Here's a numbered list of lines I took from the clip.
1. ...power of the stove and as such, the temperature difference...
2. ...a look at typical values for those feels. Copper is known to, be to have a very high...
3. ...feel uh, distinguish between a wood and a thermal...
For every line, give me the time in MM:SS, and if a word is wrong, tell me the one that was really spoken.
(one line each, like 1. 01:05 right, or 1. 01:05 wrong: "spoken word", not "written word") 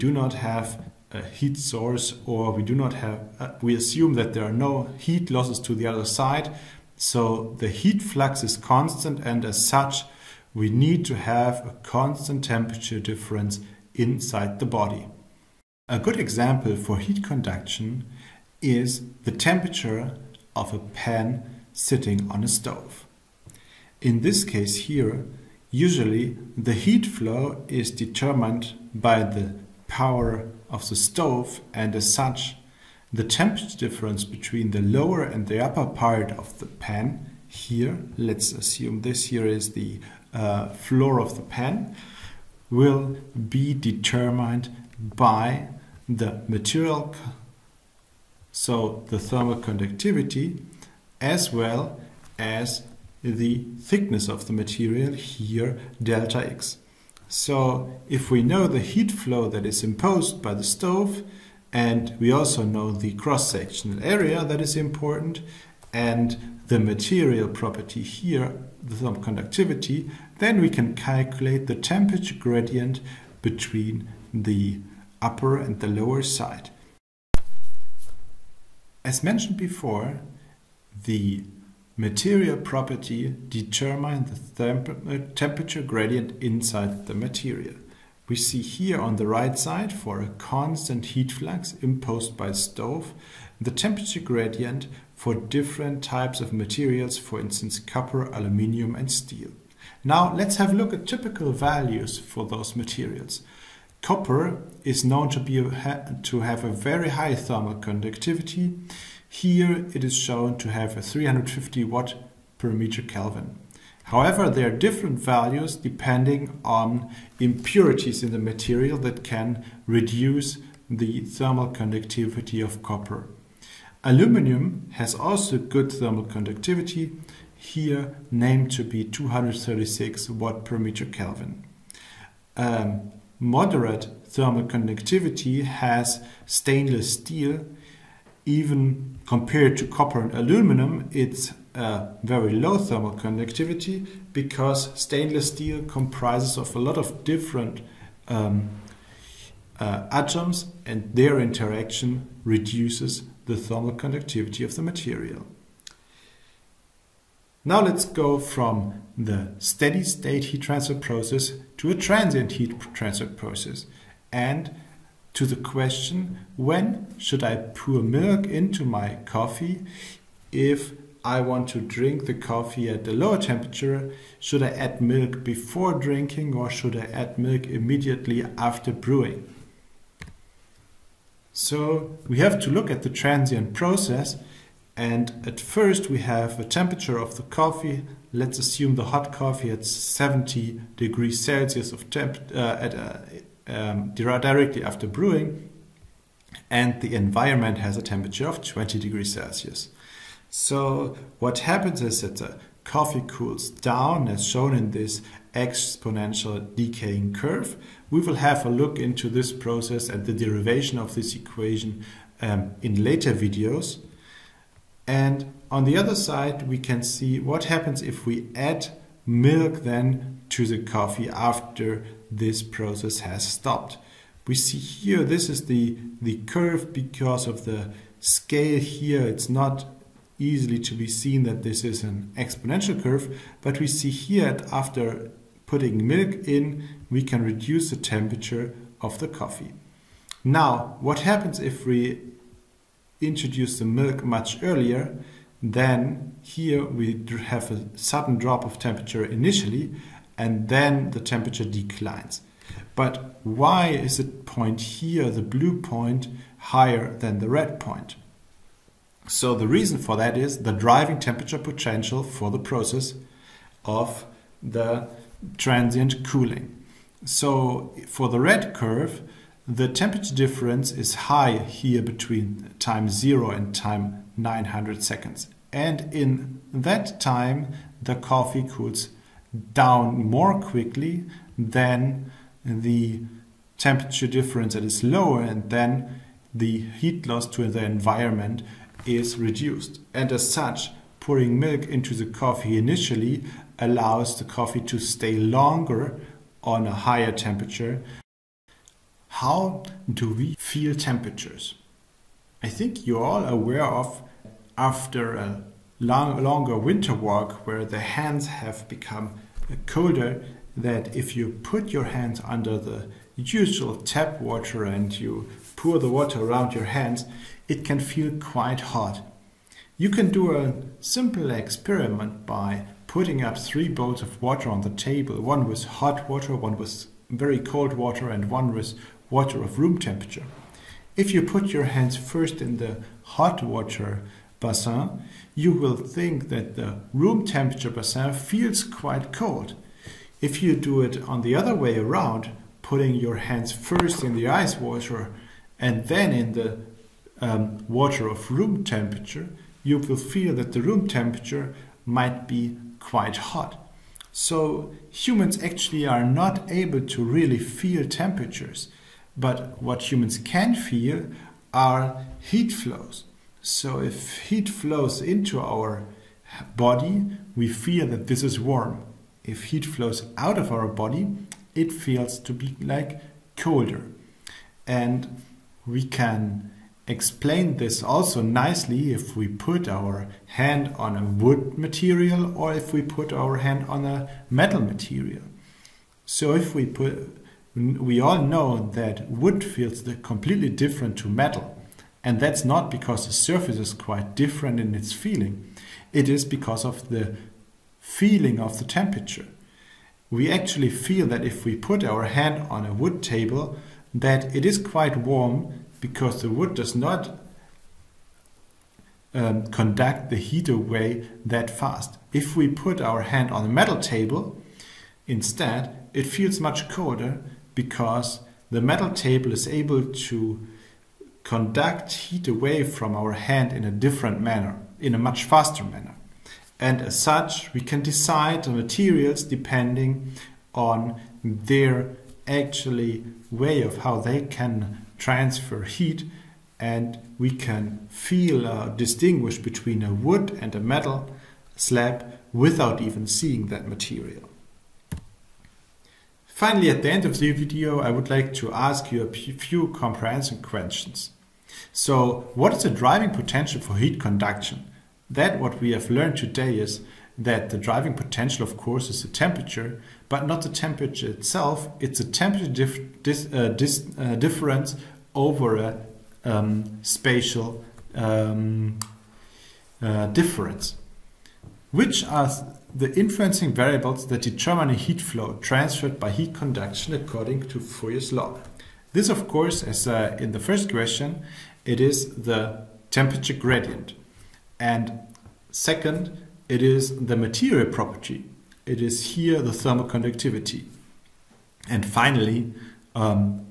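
1. 00:29 right
2. 01:40 wrong: "materials", not "feels"
3. 07:18 wrong: "metal", not "thermal".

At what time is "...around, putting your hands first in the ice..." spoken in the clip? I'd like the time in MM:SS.
05:41.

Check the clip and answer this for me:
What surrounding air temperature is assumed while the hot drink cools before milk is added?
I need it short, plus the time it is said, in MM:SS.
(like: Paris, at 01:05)
20 degrees Celsius, at 03:18.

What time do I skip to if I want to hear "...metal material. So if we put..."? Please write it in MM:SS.
06:24.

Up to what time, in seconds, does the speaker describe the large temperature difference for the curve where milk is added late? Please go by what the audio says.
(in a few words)
900 seconds.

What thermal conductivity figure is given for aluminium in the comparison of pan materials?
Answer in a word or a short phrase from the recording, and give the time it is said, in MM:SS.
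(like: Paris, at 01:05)
236 W/(m·K), at 02:09.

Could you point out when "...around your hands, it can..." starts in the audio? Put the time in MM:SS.
05:16.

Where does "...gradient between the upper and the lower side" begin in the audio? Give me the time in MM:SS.
01:12.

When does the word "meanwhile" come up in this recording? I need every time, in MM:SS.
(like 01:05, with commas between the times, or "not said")
not said.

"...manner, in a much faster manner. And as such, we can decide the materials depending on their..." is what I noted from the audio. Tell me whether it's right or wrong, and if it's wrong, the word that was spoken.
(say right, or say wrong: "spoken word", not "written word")
right.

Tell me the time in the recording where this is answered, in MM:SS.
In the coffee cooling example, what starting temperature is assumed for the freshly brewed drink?
03:09.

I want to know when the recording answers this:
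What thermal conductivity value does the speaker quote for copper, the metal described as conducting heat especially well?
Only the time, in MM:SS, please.
01:51.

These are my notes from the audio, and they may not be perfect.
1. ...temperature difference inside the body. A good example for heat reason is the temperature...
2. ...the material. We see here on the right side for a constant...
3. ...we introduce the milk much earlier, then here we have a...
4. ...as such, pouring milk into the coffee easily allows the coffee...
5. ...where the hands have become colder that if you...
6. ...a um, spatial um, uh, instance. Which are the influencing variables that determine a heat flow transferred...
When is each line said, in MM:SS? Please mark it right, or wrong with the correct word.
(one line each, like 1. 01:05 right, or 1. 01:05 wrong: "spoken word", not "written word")
1. 00:12 wrong: "conduction", not "reason"
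2. 01:27 right
3. 04:01 right
4. 04:50 wrong: "initially", not "easily"
5. 05:07 right
6. 07:45 wrong: "difference", not "instance".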